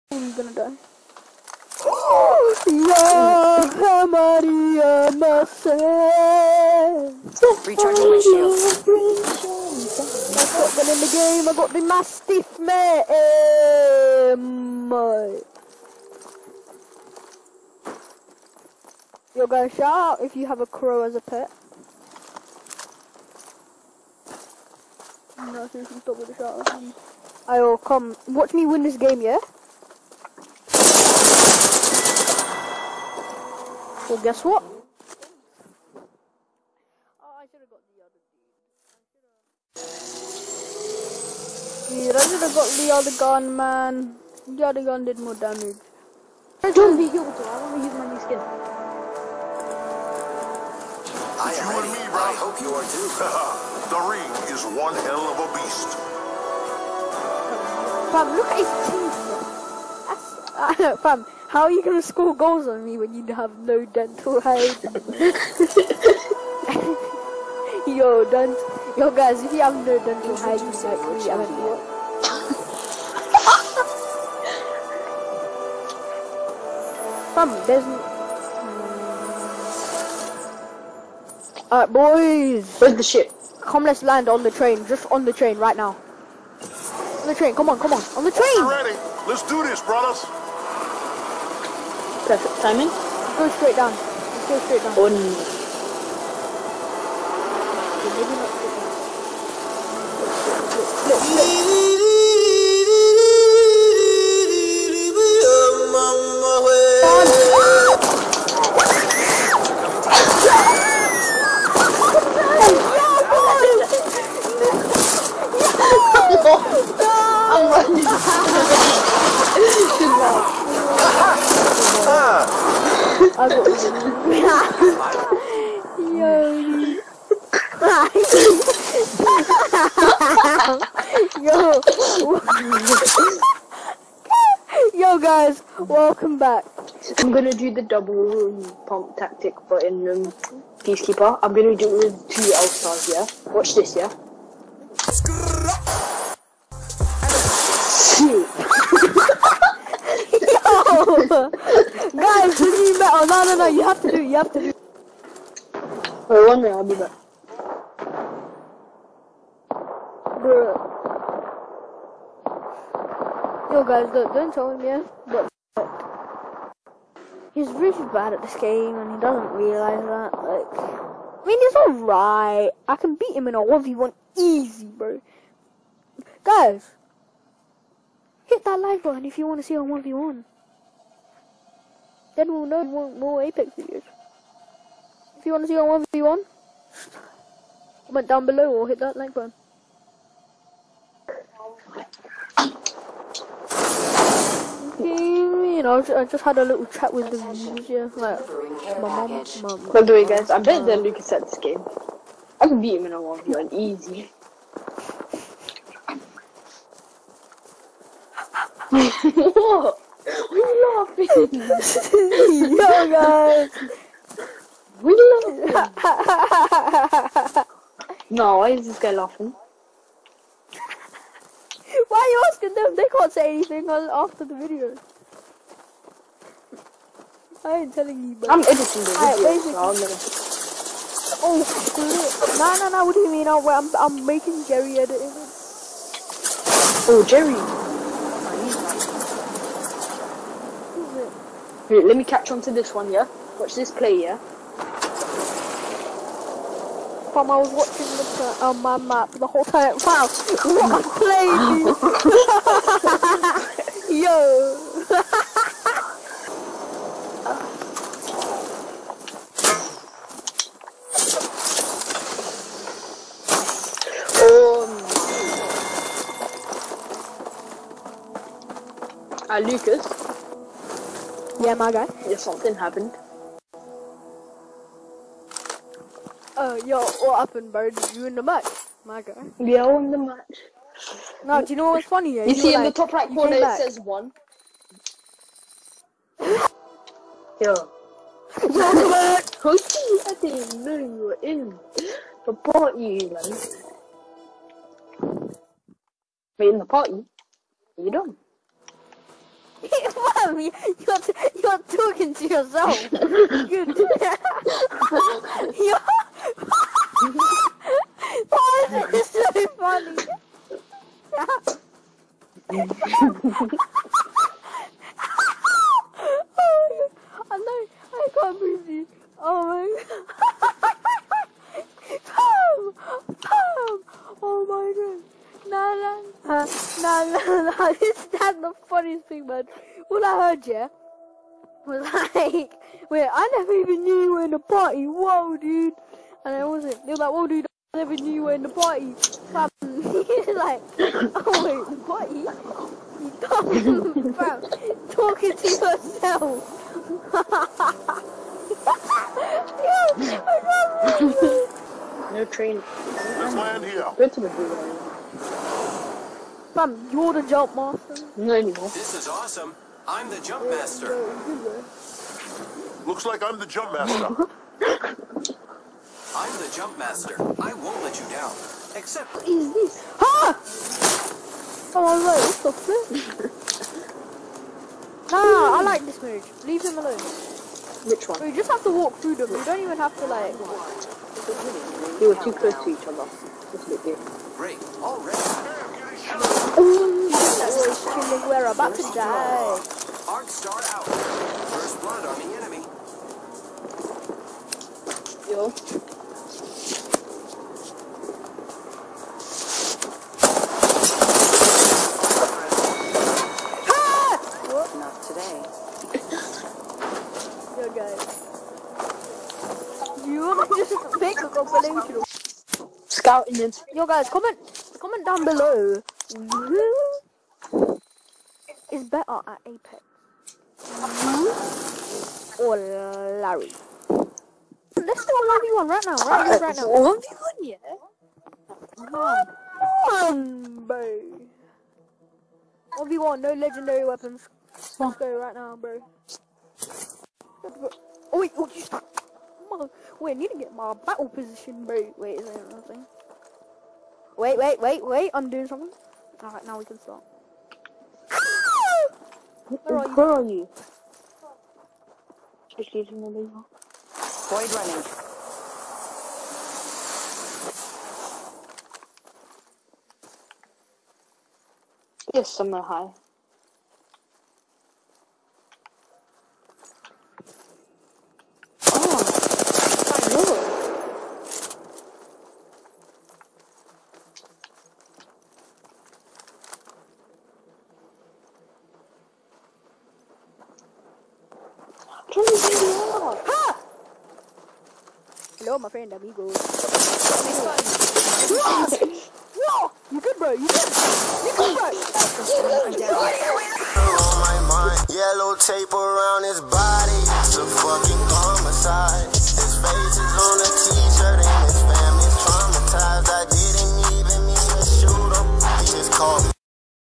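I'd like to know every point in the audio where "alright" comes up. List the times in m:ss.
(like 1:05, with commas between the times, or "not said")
1:21, 2:51, 7:26.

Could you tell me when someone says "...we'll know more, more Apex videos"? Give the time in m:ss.
3:02.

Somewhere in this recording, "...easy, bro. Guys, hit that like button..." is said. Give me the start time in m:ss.
2:54.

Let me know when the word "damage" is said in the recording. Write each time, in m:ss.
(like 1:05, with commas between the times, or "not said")
0:45.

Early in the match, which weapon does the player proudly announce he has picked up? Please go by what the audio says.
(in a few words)
Mastiff.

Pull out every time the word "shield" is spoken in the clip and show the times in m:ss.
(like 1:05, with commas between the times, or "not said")
0:08.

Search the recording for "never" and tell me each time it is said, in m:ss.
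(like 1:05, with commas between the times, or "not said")
5:33, 5:37.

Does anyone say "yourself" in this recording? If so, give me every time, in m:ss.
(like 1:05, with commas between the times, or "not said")
5:02, 5:45.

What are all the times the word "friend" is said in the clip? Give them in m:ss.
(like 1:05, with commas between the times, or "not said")
8:05.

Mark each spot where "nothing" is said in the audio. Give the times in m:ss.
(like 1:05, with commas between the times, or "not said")
7:22.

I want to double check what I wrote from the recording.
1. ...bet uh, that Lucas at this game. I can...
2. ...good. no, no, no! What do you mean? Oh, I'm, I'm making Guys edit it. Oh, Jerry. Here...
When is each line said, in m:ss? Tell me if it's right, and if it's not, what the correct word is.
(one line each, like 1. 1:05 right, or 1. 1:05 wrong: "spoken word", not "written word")
1. 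3:20 right
2. 3:51 wrong: "Jerry", not "Guys".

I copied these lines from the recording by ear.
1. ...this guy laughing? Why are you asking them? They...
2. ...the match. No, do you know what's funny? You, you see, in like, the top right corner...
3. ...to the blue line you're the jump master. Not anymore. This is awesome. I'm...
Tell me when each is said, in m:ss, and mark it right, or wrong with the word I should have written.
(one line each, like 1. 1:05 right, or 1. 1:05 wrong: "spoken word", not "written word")
1. 3:38 right
2. 4:40 right
3. 5:54 right.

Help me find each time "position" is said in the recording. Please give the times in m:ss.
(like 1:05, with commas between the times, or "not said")
7:21.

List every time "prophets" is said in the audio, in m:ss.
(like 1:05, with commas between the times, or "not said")
not said.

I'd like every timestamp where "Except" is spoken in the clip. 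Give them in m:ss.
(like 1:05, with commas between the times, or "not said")
6:08.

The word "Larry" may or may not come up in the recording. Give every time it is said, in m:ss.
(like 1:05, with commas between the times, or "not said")
7:03.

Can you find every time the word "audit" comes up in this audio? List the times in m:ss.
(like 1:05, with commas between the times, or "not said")
not said.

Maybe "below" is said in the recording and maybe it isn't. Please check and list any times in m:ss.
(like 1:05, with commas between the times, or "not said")
3:08.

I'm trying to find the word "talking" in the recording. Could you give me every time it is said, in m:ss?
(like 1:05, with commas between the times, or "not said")
5:01, 5:45.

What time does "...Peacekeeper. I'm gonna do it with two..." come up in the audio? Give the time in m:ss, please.
2:20.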